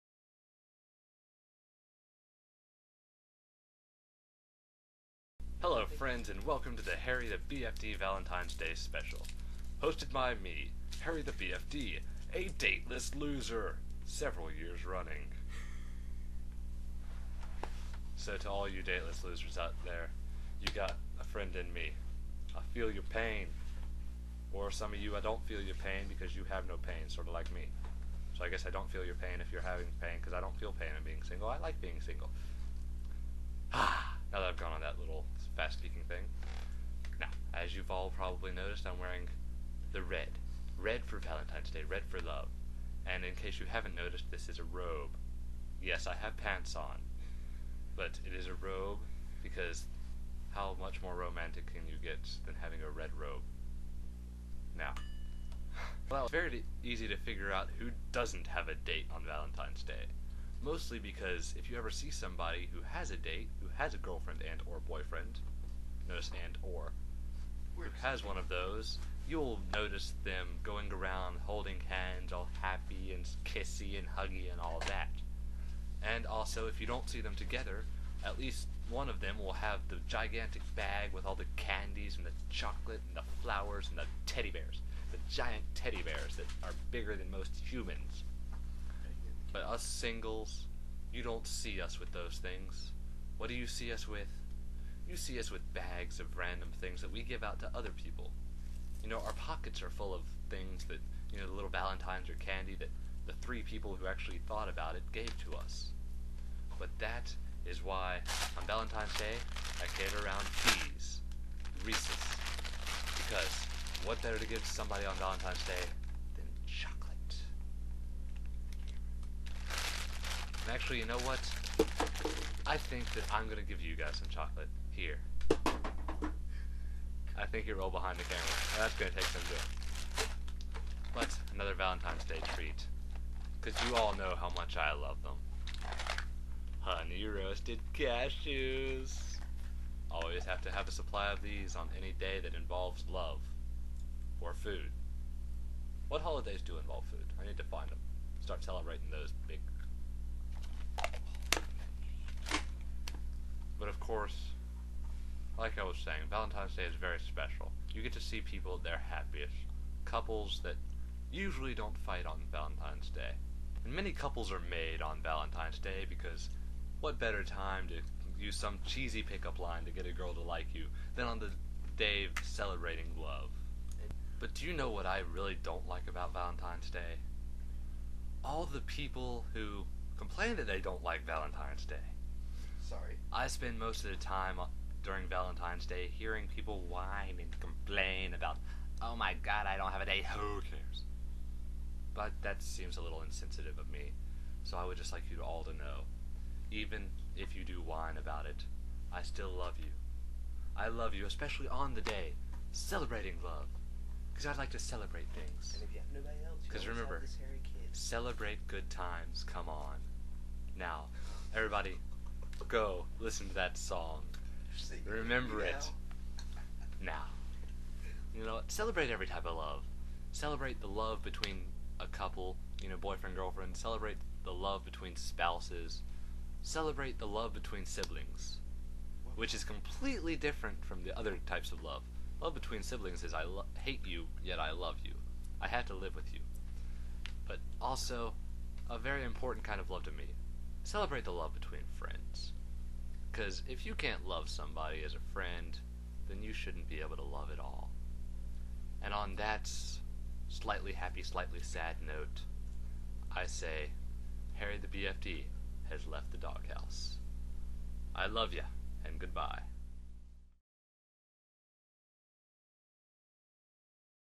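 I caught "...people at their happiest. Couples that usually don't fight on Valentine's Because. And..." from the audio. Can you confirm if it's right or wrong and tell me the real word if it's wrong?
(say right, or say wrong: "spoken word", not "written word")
wrong: "Day", not "Because".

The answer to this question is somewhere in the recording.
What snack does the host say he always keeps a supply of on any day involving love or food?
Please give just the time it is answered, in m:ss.
2:16.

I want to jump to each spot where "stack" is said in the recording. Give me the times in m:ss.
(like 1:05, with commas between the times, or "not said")
not said.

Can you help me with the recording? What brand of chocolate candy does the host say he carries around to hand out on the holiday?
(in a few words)
Reese's.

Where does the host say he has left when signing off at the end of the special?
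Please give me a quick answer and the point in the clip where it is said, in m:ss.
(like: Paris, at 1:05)
The doghouse, at 4:16.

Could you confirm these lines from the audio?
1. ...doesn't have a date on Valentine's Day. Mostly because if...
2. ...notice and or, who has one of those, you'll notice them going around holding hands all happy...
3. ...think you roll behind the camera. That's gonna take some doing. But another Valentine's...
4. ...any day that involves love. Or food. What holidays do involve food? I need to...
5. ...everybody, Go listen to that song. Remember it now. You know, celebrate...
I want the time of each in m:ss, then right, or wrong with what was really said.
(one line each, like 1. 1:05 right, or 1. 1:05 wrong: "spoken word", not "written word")
1. 0:58 right
2. 1:06 right
3. 2:07 right
4. 2:21 right
5. 3:31 right.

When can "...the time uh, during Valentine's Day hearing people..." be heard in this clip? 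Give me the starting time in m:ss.
3:04.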